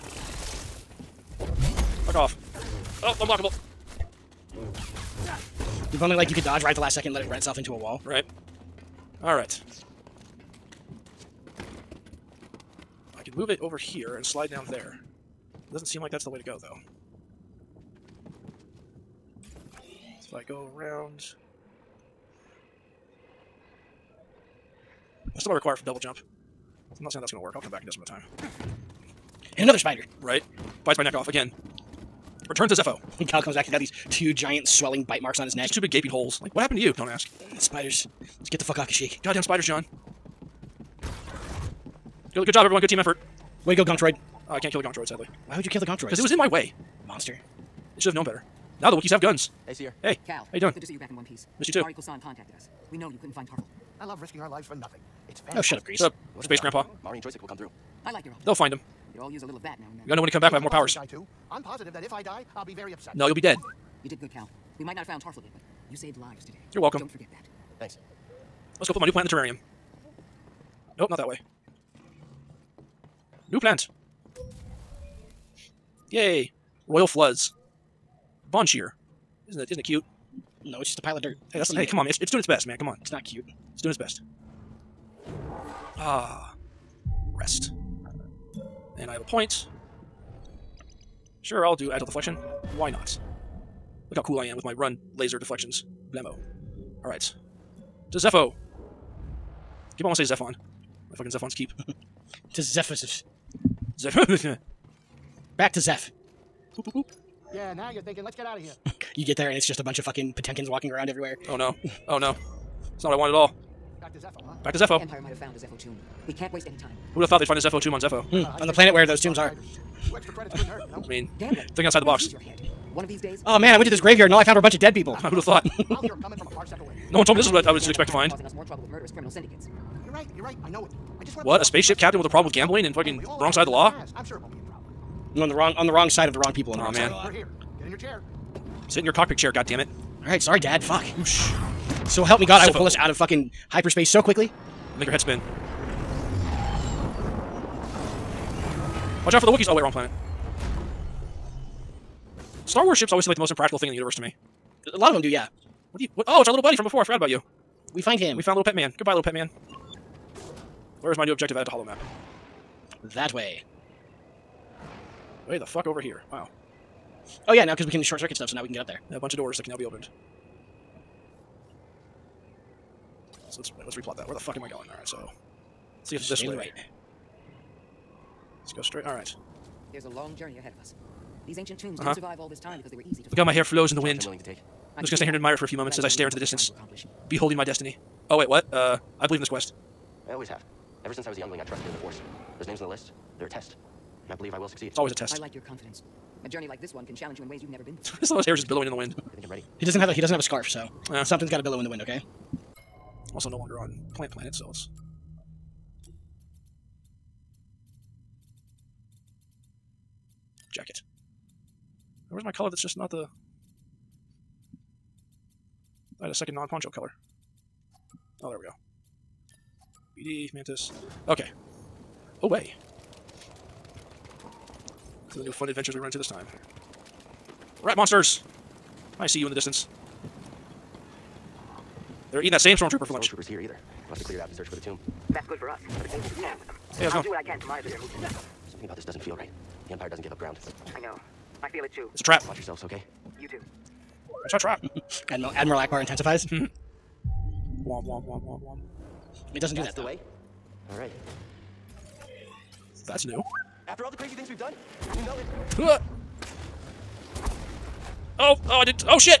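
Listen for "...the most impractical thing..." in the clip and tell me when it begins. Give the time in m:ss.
2:33.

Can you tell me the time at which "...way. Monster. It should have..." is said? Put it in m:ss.
0:46.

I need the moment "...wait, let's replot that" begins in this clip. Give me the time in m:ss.
2:53.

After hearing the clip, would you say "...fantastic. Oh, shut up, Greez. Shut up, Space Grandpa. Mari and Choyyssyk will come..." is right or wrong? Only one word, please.
right.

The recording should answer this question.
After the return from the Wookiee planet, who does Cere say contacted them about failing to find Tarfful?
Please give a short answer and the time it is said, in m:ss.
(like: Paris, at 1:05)
Mari Kosan, at 0:51.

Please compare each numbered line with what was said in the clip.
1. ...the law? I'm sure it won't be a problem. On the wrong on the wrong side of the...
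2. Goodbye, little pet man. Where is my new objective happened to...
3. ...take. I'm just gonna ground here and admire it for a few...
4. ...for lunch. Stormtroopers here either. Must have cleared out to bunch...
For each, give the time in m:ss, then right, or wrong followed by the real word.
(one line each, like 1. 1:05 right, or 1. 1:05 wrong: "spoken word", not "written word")
1. 2:13 right
2. 2:38 wrong: "added", not "happened"
3. 3:04 wrong: "stand", not "ground"
4. 3:53 wrong: "search", not "bunch".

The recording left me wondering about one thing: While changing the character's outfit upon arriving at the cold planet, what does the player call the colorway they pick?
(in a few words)
BD, Mantis.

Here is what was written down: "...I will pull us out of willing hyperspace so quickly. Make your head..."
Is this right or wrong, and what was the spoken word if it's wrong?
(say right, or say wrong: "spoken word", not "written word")
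wrong: "fucking", not "willing".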